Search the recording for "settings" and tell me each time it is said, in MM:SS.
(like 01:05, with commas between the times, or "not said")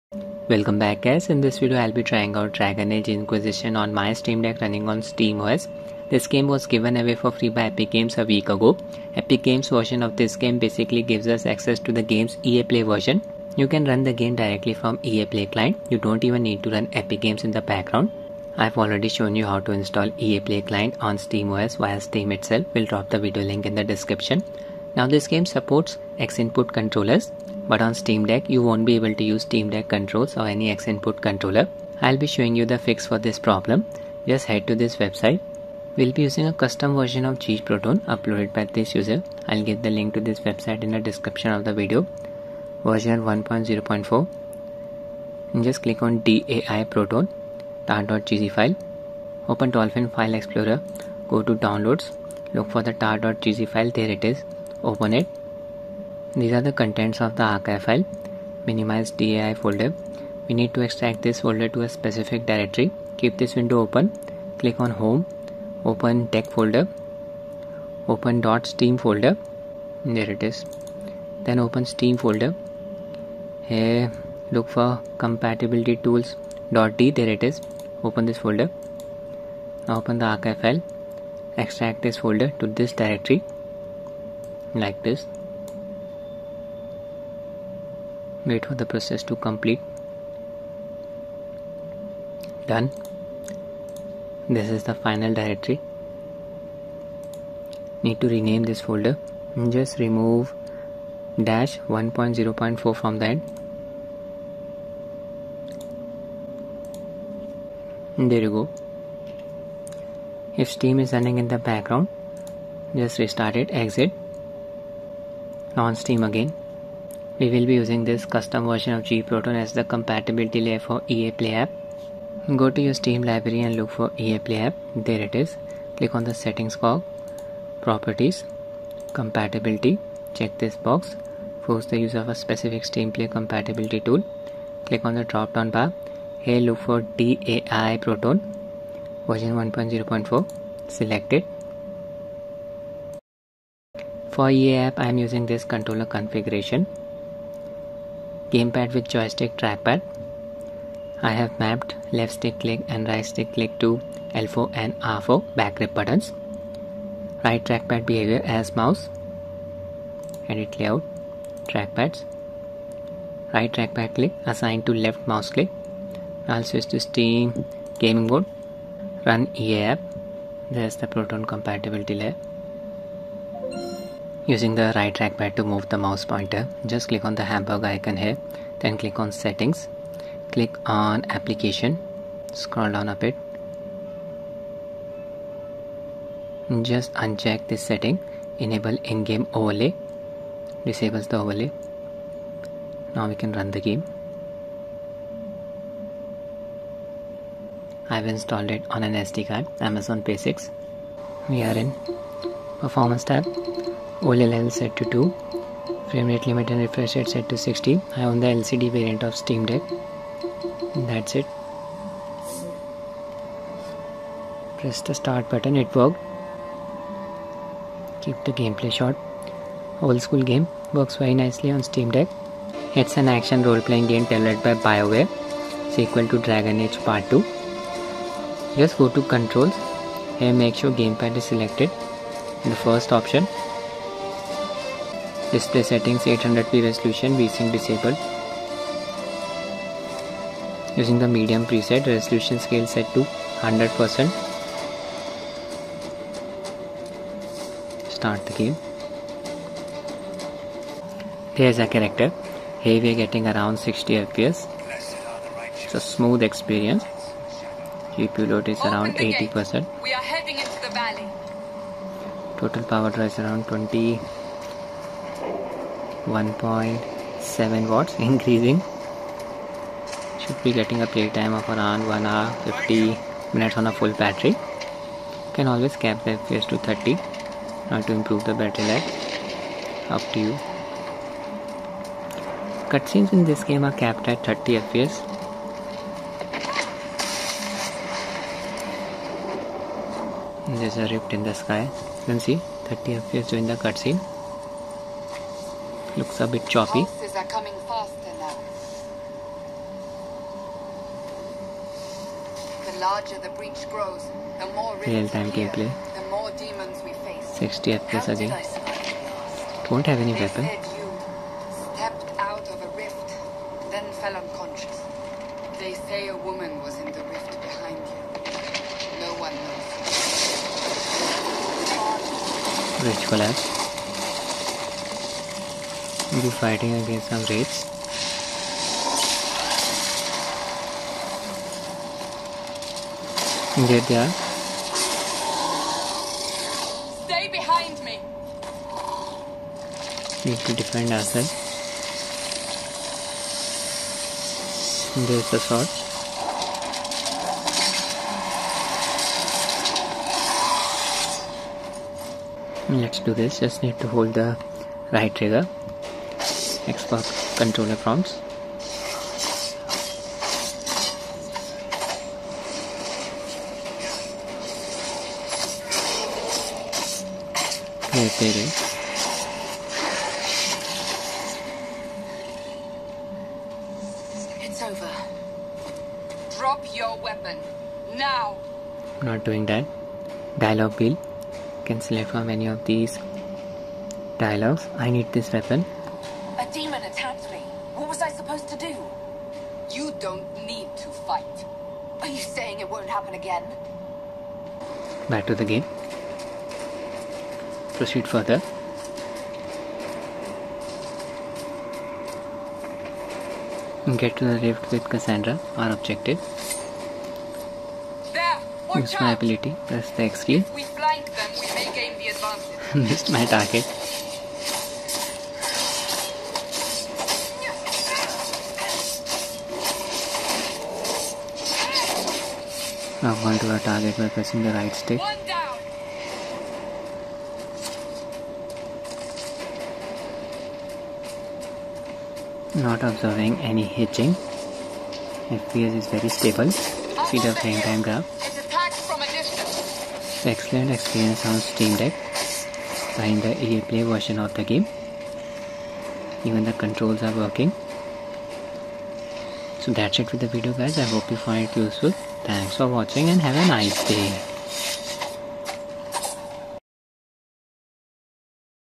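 02:06, 02:59, 03:07, 03:55.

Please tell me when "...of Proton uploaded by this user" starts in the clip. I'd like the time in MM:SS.
00:37.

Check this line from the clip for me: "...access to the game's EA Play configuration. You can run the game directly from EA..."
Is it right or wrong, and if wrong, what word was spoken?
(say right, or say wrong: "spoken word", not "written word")
wrong: "version", not "configuration".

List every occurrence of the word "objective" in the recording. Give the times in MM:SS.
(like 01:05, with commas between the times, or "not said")
06:45.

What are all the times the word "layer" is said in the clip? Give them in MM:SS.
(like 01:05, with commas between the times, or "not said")
02:00, 02:52.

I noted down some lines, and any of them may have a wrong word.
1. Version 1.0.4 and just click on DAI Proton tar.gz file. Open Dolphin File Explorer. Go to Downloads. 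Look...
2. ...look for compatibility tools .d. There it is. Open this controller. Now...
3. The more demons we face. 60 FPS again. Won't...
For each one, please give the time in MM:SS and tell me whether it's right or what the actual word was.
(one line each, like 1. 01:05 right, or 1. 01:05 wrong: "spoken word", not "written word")
1. 00:42 right
2. 01:14 wrong: "folder", not "controller"
3. 05:06 right.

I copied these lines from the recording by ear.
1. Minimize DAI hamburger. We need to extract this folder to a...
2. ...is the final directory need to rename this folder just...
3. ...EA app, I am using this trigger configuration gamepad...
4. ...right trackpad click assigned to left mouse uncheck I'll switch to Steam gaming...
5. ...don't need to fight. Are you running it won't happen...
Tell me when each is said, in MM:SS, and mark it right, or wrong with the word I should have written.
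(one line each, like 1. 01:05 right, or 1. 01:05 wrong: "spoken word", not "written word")
1. 00:58 wrong: "folder", not "hamburger"
2. 01:34 right
3. 02:24 wrong: "controller", not "trigger"
4. 02:43 wrong: "click", not "uncheck"
5. 06:30 wrong: "saying", not "running".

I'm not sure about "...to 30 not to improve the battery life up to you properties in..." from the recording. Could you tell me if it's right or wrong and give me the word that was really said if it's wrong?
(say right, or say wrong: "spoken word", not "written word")
wrong: "cutscenes", not "properties".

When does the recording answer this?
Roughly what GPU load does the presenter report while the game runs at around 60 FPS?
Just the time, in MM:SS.
04:18.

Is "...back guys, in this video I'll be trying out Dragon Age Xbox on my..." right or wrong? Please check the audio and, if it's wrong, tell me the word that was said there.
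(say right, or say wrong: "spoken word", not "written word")
wrong: "Inquisition", not "Xbox".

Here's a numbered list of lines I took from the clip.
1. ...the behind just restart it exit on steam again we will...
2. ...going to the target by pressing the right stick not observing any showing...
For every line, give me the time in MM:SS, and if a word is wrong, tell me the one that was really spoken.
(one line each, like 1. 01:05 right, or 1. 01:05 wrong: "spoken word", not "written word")
1. 01:51 wrong: "background", not "behind"
2. 07:03 wrong: "hitching", not "showing".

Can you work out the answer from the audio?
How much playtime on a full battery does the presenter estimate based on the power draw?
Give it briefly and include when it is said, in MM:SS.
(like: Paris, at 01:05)
1 hour 50 minutes, at 04:32.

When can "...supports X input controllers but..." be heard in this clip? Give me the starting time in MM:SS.
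00:25.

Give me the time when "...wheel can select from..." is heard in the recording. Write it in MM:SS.
06:20.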